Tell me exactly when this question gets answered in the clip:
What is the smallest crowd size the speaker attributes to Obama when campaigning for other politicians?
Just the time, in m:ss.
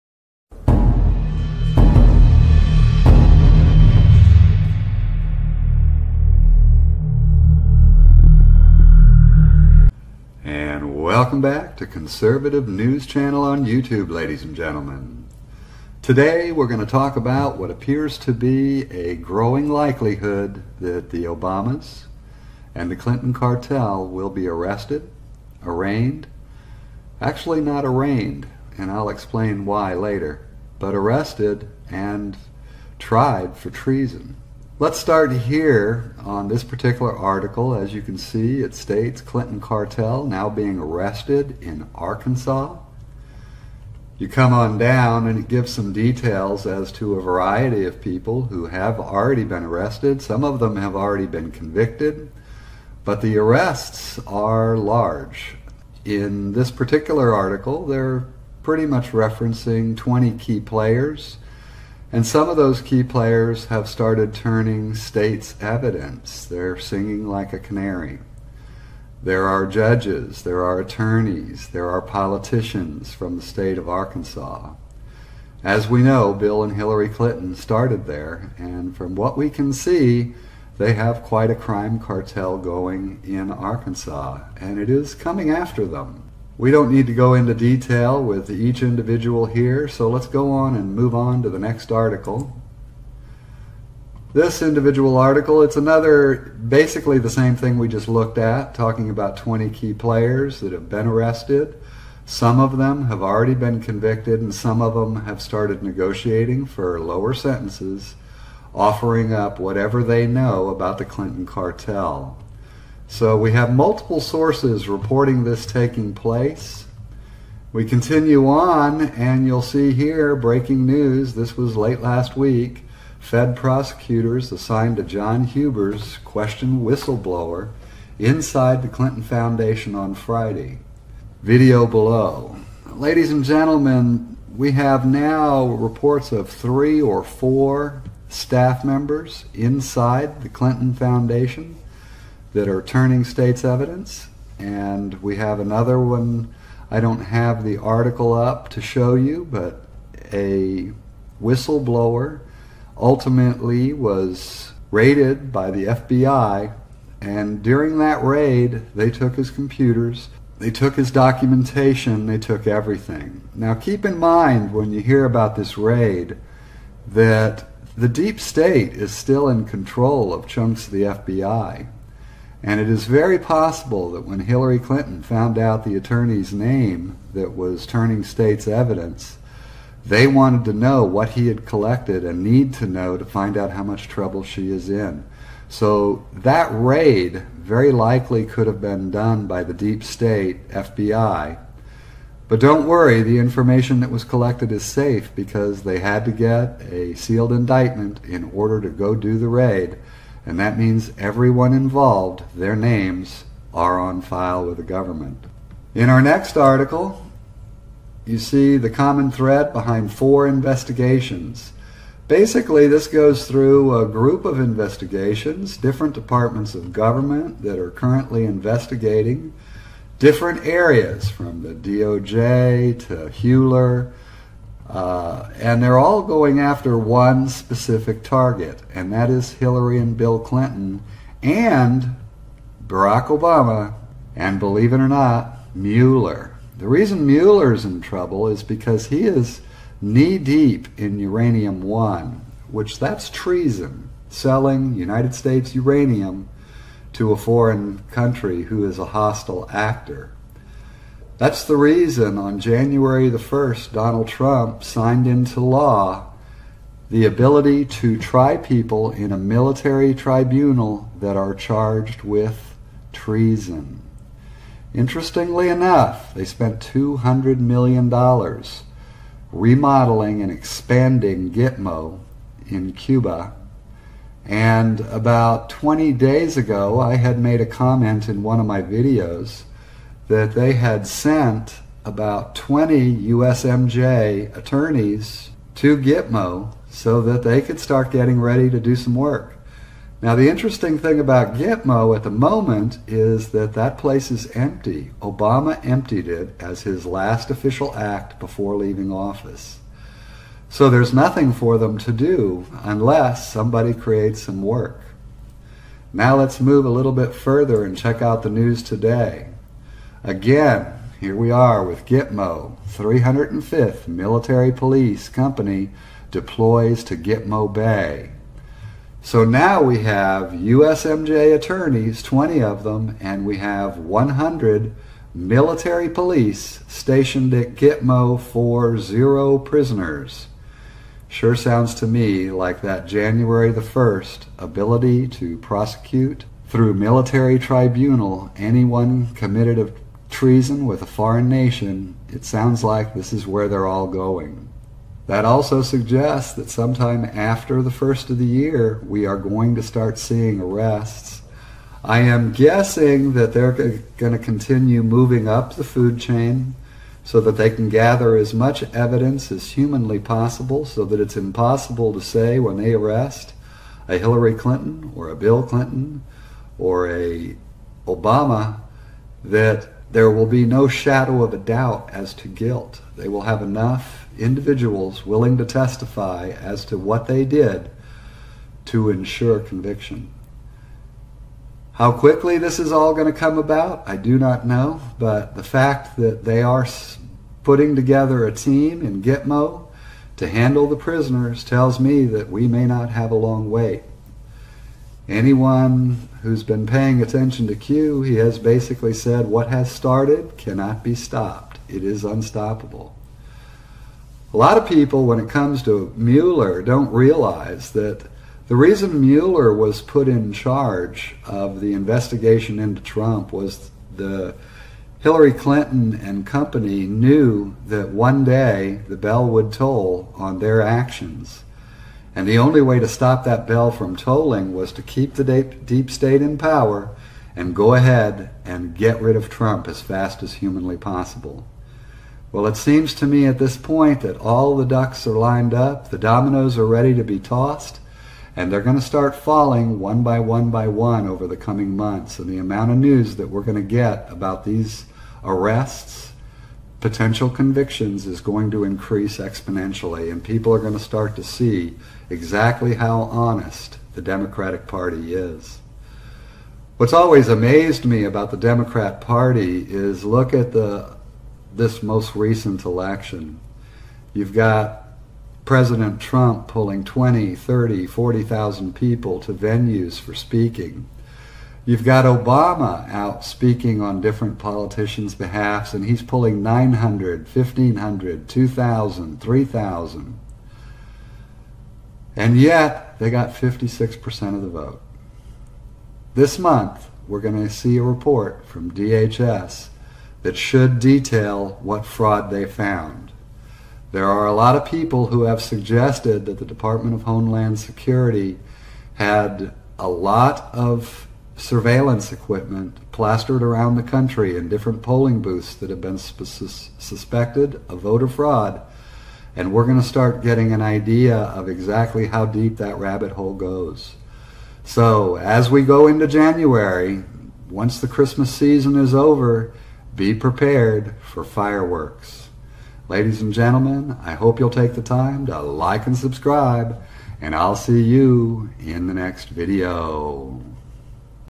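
7:56.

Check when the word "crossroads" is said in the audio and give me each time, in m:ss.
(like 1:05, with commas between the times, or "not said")
not said.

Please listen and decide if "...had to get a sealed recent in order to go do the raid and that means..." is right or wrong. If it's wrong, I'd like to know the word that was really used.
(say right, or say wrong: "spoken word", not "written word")
wrong: "indictment", not "recent".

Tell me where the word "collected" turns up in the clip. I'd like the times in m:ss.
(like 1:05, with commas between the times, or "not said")
3:01, 3:14.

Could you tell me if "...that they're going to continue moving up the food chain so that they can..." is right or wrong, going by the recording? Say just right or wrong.
right.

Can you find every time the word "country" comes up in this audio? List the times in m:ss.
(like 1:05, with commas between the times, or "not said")
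4:08, 8:24.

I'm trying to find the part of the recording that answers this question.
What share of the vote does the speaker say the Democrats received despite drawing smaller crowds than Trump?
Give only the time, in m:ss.
8:03.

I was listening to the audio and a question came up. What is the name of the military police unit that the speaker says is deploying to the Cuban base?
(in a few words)
305th Military Police Company.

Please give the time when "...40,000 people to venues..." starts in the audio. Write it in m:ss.
7:48.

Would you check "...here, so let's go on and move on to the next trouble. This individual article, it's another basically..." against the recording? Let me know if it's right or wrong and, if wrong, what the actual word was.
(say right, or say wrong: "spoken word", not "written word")
wrong: "article", not "trouble".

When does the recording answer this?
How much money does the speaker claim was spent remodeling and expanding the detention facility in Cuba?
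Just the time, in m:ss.
4:26.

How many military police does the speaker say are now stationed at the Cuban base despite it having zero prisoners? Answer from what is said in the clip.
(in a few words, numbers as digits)
100.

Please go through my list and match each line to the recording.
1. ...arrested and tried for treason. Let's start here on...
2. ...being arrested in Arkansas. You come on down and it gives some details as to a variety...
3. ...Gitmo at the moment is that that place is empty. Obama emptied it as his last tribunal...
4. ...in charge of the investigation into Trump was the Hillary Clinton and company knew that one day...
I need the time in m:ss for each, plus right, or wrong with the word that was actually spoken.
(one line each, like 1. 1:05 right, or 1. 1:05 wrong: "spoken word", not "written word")
1. 0:30 right
2. 0:40 right
3. 4:51 wrong: "official", not "tribunal"
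4. 6:50 right.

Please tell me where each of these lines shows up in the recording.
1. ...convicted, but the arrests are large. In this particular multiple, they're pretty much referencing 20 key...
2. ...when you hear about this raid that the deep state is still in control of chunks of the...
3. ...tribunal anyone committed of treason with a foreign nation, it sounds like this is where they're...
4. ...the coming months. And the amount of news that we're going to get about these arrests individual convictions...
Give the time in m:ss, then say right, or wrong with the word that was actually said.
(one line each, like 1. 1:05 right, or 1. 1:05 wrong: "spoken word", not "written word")
1. 0:51 wrong: "article", not "multiple"
2. 2:44 right
3. 5:37 right
4. 7:21 wrong: "potential", not "individual".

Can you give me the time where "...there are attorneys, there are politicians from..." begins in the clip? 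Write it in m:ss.
1:10.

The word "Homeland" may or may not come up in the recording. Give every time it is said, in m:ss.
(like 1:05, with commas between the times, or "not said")
8:17.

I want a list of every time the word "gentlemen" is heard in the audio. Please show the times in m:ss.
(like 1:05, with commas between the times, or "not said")
0:14, 2:13, 8:43.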